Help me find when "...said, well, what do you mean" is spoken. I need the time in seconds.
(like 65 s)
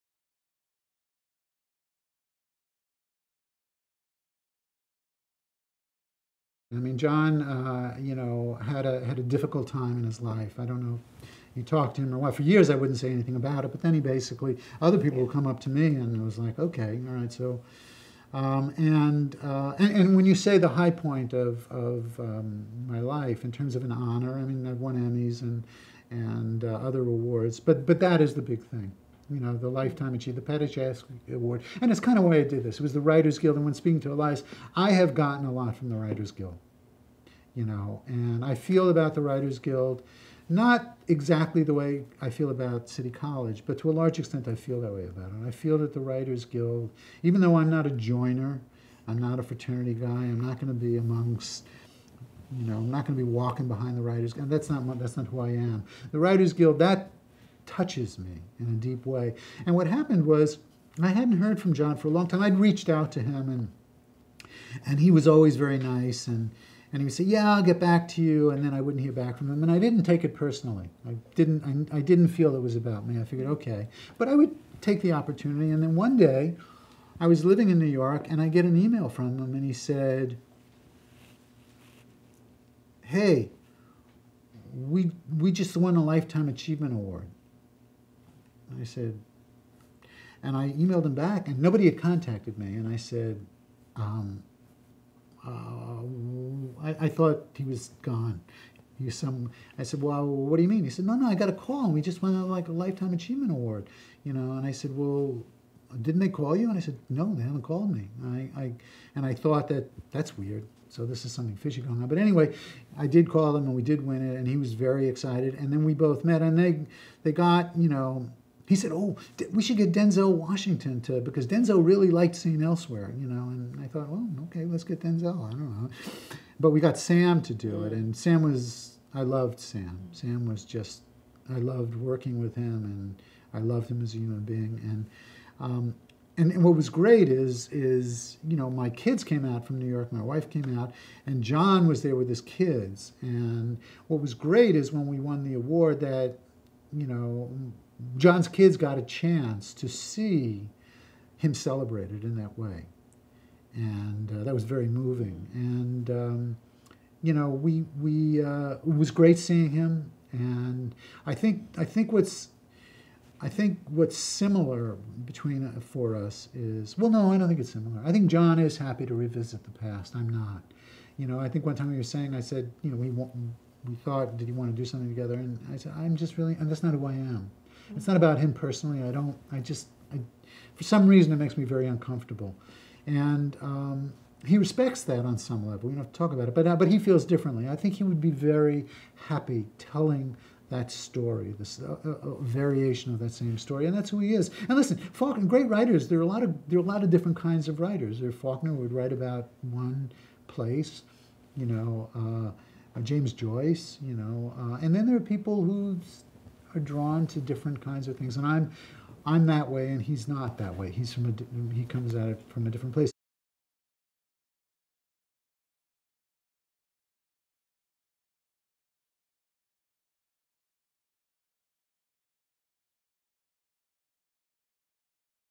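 99 s.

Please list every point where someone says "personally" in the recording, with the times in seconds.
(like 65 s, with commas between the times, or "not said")
70 s, 178 s.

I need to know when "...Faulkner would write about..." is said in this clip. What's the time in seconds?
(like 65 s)
198 s.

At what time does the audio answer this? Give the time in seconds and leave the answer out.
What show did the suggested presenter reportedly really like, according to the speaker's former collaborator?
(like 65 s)
122 s.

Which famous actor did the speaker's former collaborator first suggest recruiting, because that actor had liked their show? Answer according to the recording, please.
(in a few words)
Denzel Washington.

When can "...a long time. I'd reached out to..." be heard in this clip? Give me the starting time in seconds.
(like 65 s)
62 s.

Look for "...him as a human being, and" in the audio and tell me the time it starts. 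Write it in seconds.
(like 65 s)
133 s.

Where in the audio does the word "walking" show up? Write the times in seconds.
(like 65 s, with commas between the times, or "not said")
53 s.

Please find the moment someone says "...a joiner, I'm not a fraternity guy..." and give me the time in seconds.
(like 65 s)
47 s.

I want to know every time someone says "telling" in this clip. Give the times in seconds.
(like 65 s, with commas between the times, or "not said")
189 s.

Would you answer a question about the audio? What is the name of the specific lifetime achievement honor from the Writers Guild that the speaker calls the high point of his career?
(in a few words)
Paddy Chayefsky Award.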